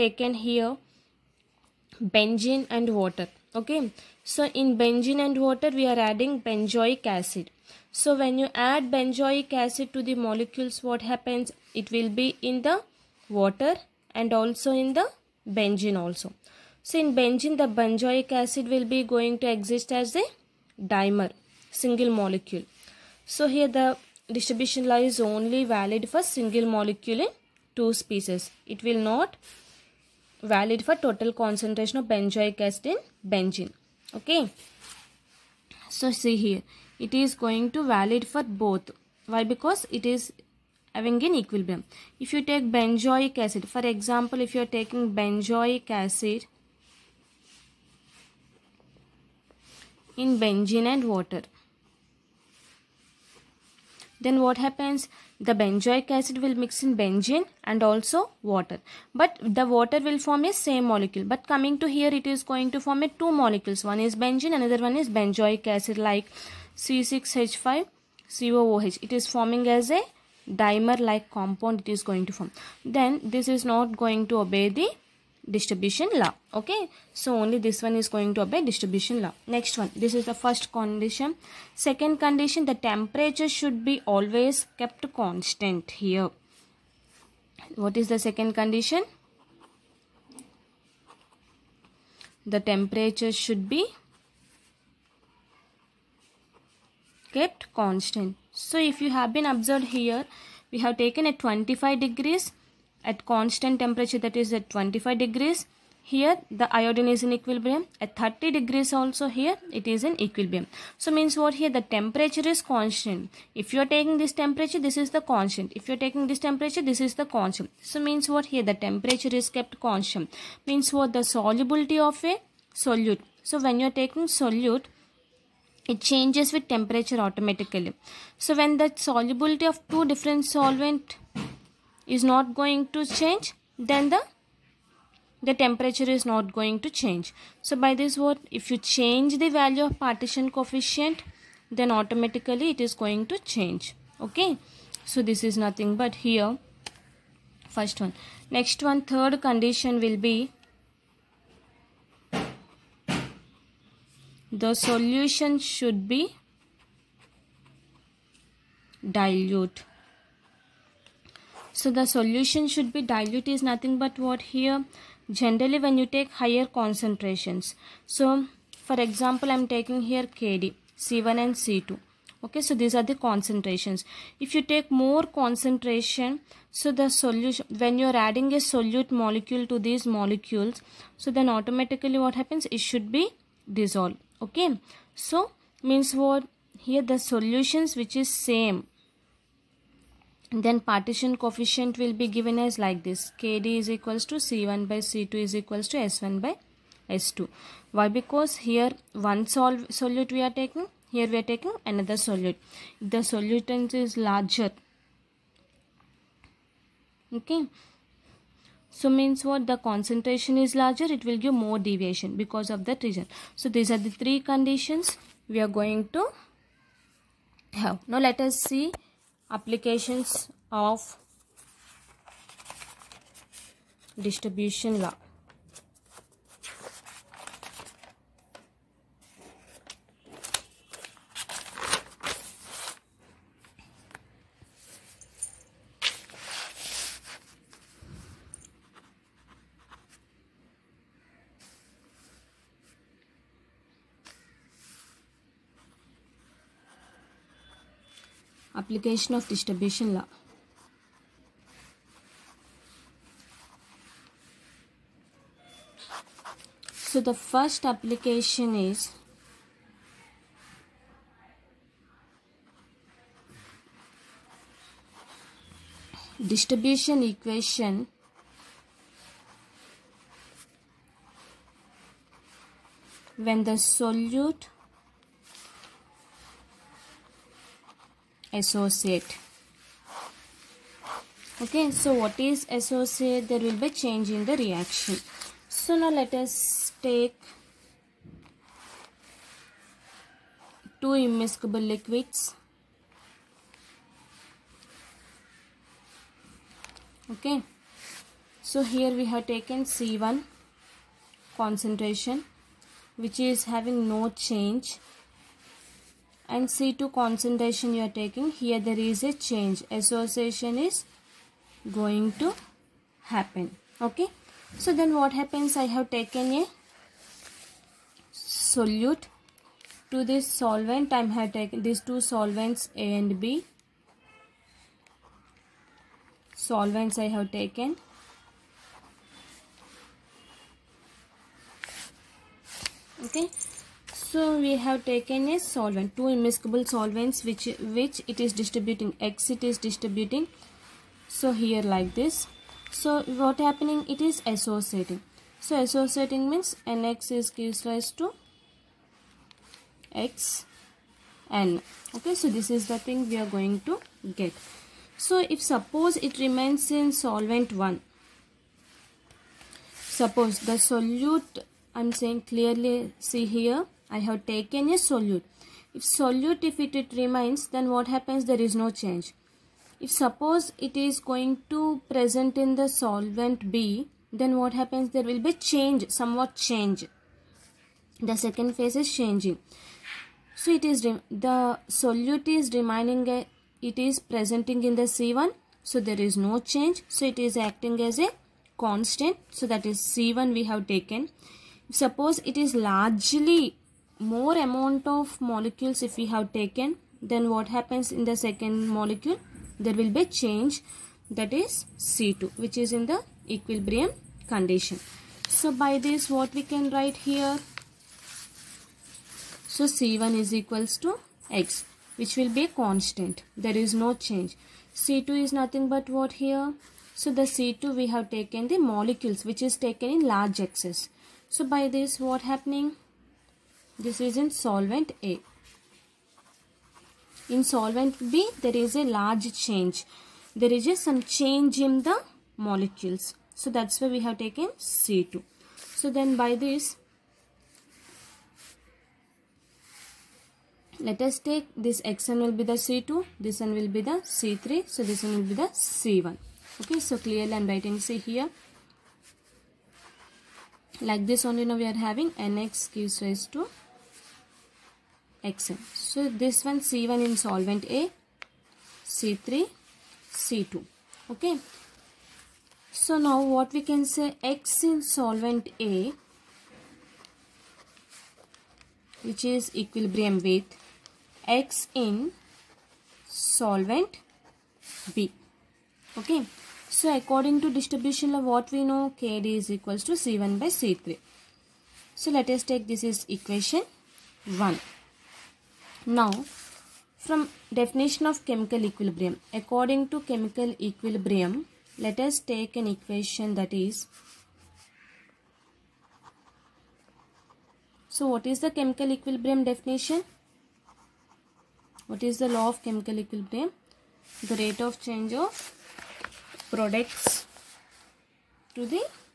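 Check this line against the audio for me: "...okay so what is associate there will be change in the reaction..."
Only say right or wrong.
right.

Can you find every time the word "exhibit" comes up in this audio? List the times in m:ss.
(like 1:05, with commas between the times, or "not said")
not said.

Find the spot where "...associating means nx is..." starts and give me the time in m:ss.
5:45.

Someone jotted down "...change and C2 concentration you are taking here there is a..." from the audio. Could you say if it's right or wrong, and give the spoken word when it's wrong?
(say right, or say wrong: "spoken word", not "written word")
right.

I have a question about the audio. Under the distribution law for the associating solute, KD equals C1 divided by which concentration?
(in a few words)
C3.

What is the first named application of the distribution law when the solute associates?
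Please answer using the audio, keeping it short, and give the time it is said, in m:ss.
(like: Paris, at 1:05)
distribution equation, at 4:26.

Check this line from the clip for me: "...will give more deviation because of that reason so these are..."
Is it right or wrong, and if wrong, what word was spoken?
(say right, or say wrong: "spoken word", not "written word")
right.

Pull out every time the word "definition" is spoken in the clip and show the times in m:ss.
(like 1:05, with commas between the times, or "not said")
8:07, 8:19.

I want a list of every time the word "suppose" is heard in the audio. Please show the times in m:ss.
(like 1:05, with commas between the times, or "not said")
5:55, 6:00, 6:10, 6:31.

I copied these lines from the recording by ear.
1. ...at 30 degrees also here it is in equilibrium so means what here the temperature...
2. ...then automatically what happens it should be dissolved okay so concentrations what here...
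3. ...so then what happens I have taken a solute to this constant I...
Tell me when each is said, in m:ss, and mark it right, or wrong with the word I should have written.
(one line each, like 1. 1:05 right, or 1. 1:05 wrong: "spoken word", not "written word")
1. 1:48 right
2. 3:01 wrong: "means", not "concentrations"
3. 5:14 wrong: "solvent", not "constant".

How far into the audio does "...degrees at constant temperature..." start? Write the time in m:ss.
1:42.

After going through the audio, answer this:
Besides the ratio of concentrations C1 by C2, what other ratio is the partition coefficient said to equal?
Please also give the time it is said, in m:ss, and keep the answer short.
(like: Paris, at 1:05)
S1 by S2, at 3:15.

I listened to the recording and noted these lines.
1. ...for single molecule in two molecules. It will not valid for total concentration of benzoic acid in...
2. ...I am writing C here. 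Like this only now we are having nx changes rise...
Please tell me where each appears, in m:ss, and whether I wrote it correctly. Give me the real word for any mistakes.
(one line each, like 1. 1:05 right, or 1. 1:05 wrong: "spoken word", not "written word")
1. 0:26 wrong: "species", not "molecules"
2. 7:27 wrong: "gives", not "changes".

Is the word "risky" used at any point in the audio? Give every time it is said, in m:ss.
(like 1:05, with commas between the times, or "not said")
not said.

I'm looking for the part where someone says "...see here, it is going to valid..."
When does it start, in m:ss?
0:36.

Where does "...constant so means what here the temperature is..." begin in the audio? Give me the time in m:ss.
1:57.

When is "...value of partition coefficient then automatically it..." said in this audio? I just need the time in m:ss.
2:19.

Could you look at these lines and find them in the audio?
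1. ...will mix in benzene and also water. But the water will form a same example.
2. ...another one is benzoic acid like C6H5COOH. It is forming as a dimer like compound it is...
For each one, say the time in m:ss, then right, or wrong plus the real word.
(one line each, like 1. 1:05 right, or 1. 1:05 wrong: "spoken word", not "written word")
1. 0:56 wrong: "molecule", not "example"
2. 1:04 right.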